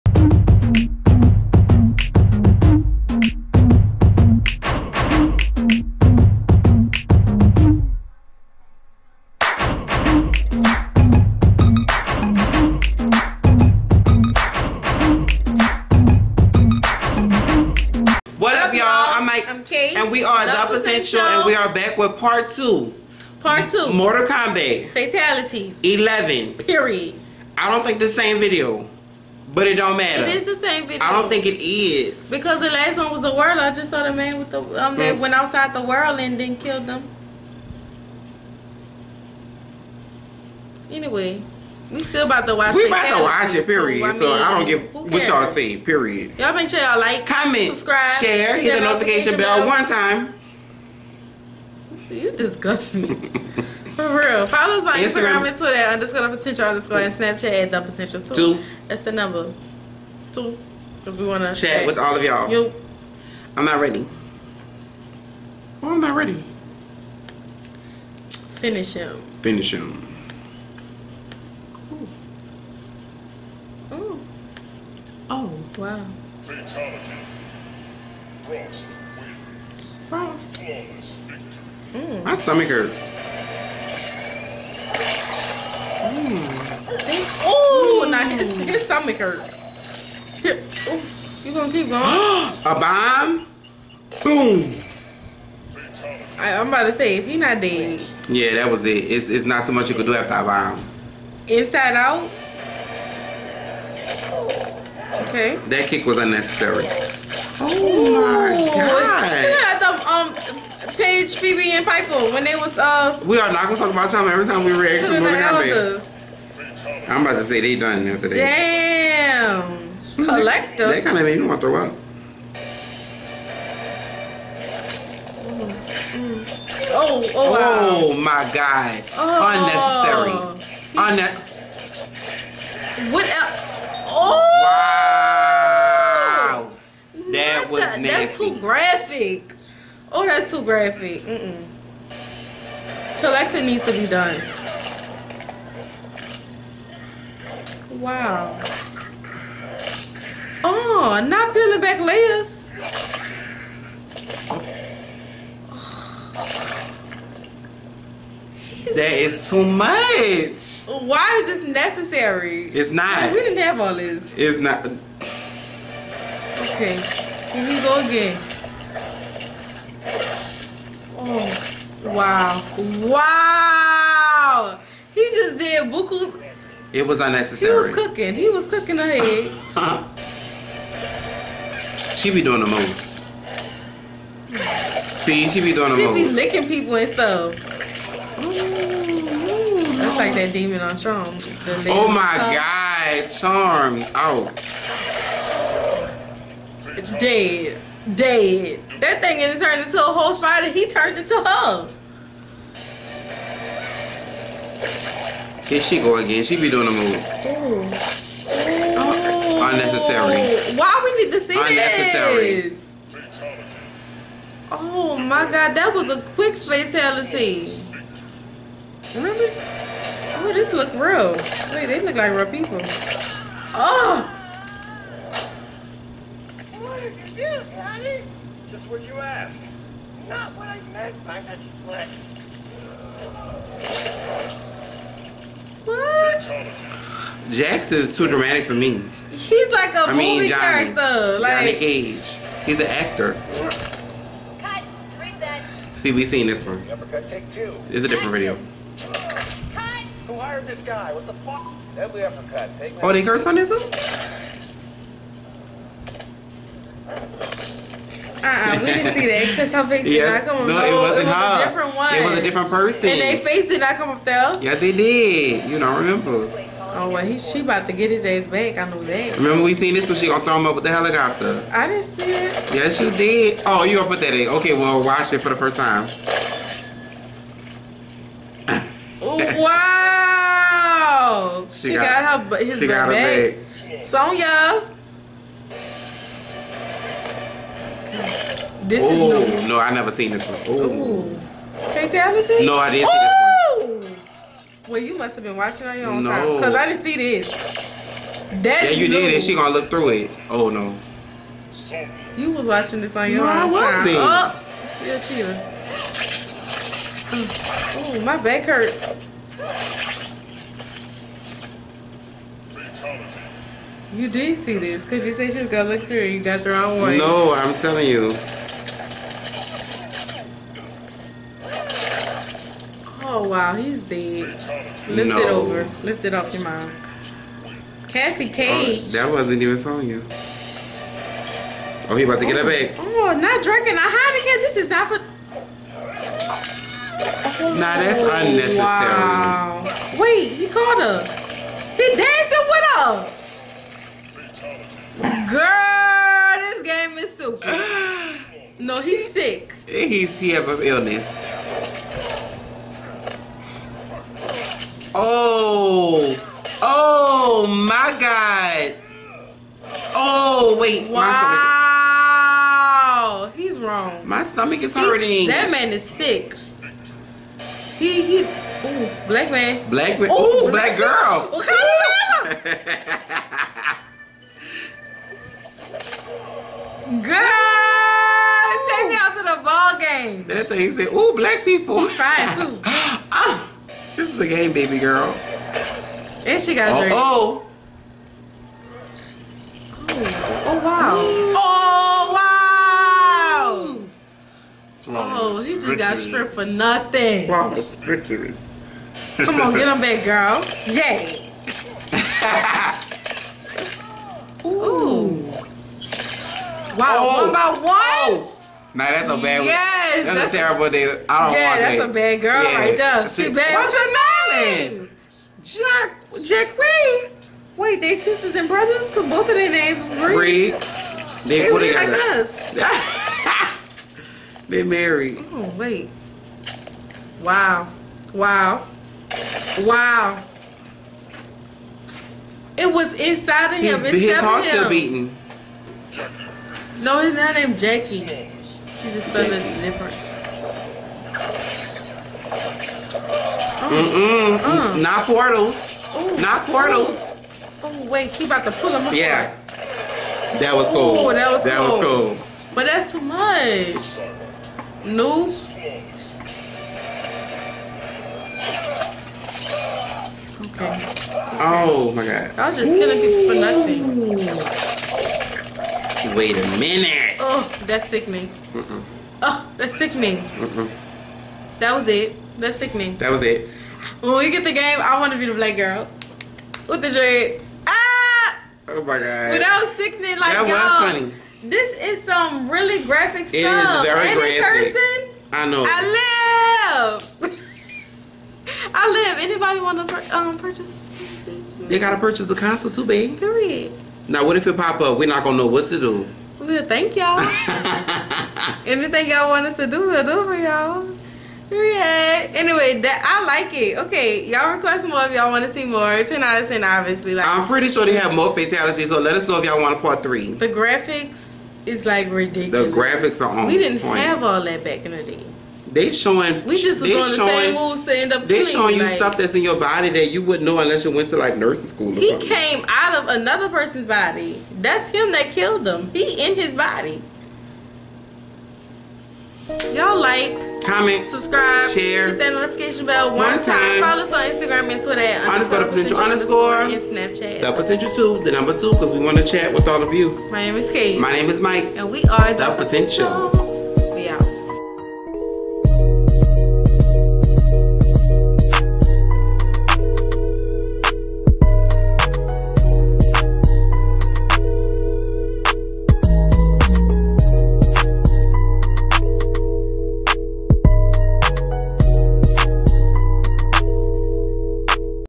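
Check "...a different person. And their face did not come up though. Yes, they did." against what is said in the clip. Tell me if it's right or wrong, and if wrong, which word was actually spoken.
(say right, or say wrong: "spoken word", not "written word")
right.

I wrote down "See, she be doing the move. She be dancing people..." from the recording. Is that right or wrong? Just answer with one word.
wrong.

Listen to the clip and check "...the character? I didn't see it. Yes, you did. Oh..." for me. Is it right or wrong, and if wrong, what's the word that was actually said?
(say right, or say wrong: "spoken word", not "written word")
wrong: "helicopter", not "character".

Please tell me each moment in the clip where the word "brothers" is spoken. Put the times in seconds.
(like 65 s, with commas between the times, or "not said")
418 s.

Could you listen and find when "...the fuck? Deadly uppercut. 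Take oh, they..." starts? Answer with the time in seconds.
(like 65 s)
251 s.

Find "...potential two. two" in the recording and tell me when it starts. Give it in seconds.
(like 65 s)
57 s.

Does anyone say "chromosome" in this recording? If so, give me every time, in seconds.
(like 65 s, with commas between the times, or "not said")
not said.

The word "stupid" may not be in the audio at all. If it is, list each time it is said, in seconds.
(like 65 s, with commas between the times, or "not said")
347 s.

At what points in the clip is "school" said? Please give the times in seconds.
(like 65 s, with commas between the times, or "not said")
521 s.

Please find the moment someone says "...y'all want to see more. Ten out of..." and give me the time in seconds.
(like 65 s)
505 s.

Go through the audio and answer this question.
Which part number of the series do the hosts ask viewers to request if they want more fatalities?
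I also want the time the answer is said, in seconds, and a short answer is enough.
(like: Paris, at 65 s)
3, at 510 s.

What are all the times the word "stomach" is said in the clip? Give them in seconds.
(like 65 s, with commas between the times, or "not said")
82 s, 88 s, 364 s.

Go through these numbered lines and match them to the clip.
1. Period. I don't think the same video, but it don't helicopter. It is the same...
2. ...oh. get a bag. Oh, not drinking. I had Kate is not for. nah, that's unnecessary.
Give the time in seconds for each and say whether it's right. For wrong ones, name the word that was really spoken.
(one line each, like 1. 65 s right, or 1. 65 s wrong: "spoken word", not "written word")
1. 26 s wrong: "matter", not "helicopter"
2. 332 s wrong: "This", not "Kate".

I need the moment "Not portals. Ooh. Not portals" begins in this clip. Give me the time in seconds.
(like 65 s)
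445 s.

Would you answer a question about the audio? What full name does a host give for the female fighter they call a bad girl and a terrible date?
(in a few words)
Jack Reed.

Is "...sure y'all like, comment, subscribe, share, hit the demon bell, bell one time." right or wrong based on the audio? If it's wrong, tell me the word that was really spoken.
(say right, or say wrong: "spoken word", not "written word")
wrong: "notification", not "demon".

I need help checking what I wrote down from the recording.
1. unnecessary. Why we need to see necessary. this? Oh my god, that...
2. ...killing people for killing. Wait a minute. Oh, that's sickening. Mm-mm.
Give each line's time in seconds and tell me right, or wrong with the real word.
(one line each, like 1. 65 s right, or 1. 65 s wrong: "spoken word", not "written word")
1. 209 s wrong: "unnecessary", not "necessary"
2. 462 s wrong: "nothing", not "killing".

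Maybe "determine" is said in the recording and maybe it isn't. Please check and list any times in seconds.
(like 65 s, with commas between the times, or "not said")
not said.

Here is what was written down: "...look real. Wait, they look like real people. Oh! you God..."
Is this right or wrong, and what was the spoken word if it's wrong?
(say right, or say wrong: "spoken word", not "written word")
wrong: "Just", not "God".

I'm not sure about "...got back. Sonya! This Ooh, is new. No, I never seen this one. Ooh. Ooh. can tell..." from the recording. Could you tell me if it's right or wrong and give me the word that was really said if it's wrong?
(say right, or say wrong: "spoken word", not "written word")
right.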